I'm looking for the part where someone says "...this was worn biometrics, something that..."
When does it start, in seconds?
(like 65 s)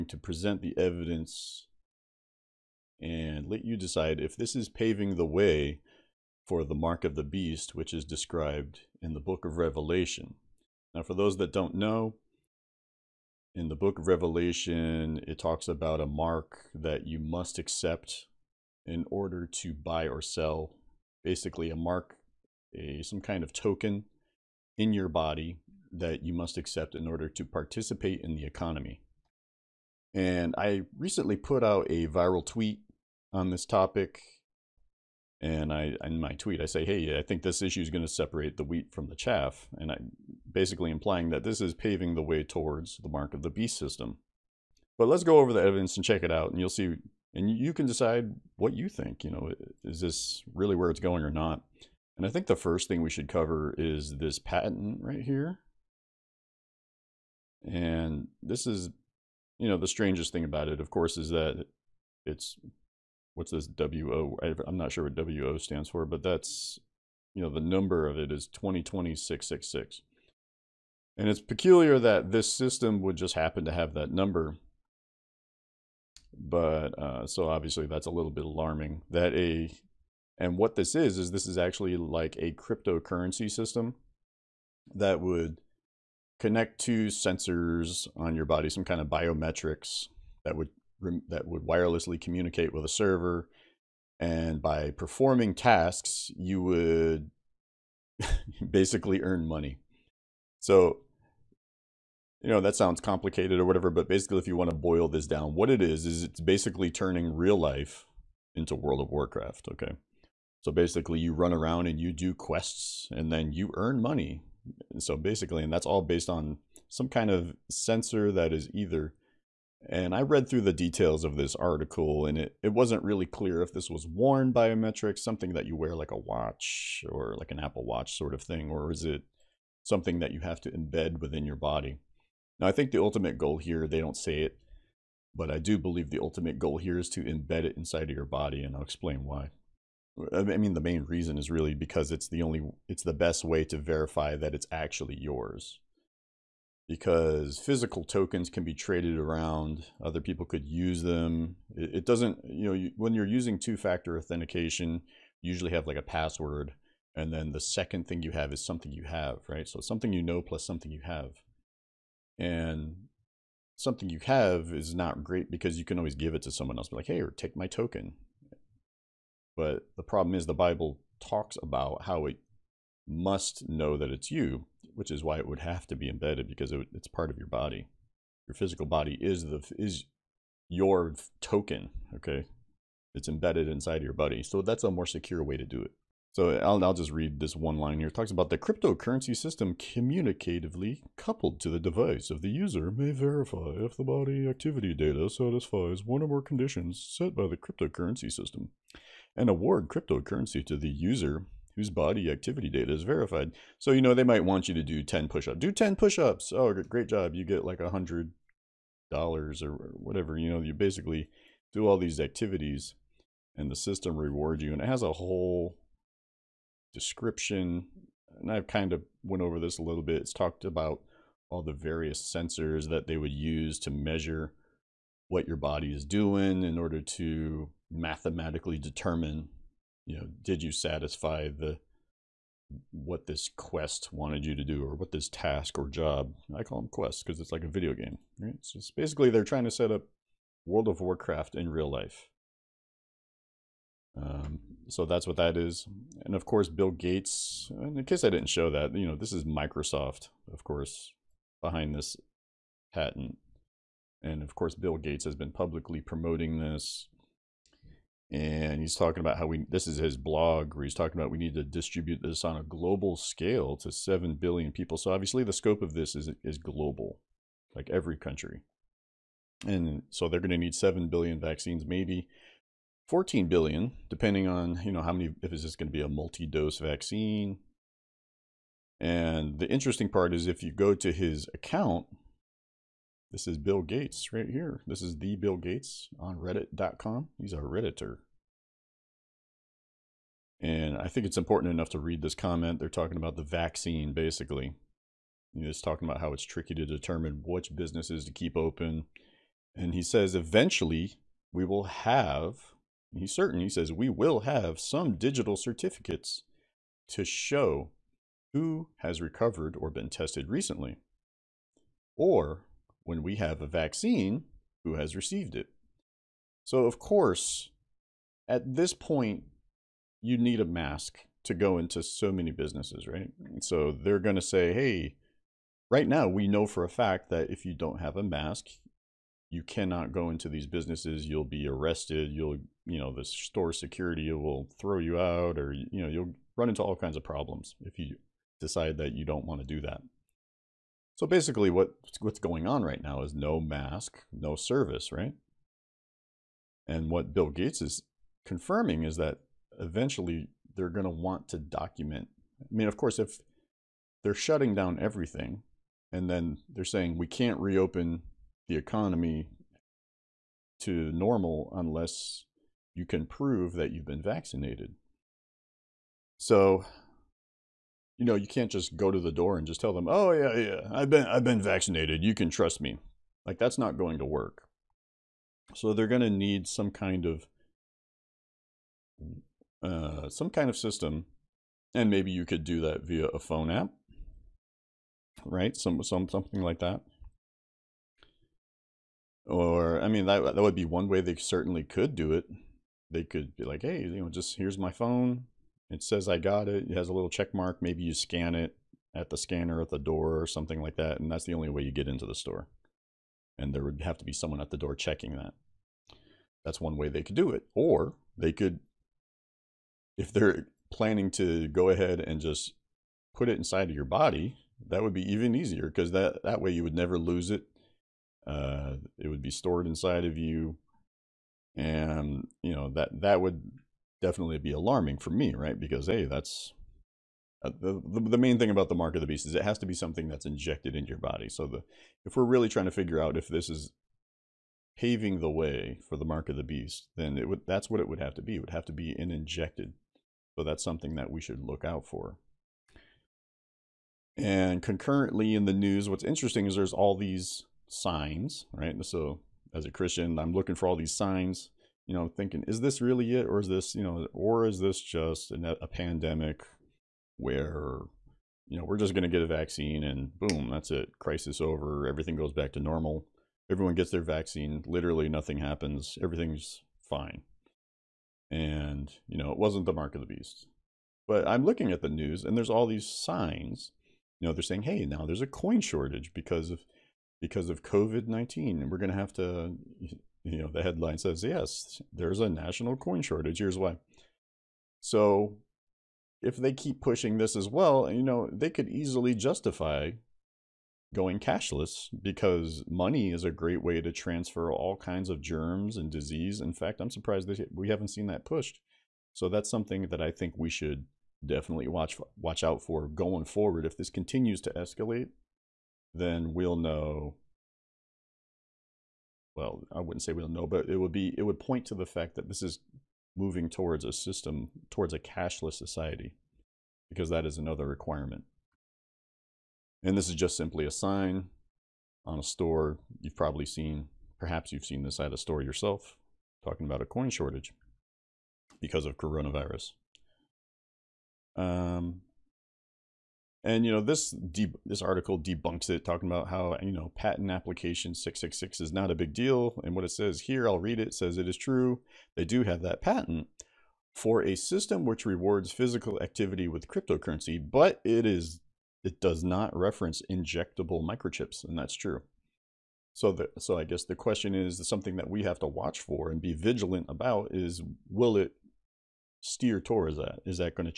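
123 s.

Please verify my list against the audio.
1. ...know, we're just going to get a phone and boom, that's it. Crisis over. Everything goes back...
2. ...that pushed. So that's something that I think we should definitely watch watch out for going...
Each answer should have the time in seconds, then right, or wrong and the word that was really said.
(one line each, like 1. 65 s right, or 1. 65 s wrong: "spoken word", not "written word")
1. 458 s wrong: "vaccine", not "phone"
2. 498 s right.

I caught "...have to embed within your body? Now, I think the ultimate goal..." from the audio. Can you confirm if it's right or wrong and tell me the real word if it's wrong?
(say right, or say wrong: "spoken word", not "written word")
right.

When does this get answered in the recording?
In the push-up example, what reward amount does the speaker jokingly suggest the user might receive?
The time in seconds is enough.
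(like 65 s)
207 s.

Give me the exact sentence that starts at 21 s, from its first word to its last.
Basically, a mark, a some kind of token in your body that you must accept in order to participate in the economy.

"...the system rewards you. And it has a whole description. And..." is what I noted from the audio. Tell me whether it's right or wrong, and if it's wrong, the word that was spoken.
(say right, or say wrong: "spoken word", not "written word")
right.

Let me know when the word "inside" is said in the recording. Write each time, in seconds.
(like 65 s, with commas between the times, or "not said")
137 s, 183 s, 413 s, 419 s.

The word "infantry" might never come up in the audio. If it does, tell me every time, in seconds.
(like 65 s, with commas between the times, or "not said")
not said.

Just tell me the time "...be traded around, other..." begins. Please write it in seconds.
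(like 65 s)
148 s.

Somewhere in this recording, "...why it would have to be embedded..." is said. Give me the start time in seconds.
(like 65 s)
175 s.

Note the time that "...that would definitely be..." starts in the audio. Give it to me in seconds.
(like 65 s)
423 s.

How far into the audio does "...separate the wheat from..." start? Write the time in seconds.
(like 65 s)
38 s.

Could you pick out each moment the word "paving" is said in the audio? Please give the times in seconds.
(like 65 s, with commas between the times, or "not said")
4 s, 41 s, 434 s.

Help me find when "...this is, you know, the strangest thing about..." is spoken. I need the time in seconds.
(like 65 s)
58 s.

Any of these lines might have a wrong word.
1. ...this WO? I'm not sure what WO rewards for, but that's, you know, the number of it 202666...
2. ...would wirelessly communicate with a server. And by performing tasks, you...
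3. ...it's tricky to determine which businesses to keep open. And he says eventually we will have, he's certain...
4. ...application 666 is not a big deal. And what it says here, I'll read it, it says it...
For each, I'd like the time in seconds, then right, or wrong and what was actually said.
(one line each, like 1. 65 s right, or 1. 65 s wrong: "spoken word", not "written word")
1. 63 s wrong: "stands", not "rewards"
2. 91 s right
3. 296 s right
4. 537 s right.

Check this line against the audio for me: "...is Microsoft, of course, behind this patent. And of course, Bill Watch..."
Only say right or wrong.
wrong.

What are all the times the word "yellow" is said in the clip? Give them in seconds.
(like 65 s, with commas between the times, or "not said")
not said.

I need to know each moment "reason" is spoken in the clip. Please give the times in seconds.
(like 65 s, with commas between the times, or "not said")
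141 s.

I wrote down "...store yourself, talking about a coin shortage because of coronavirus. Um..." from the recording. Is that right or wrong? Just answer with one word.
right.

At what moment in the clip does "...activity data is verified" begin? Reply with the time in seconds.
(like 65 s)
202 s.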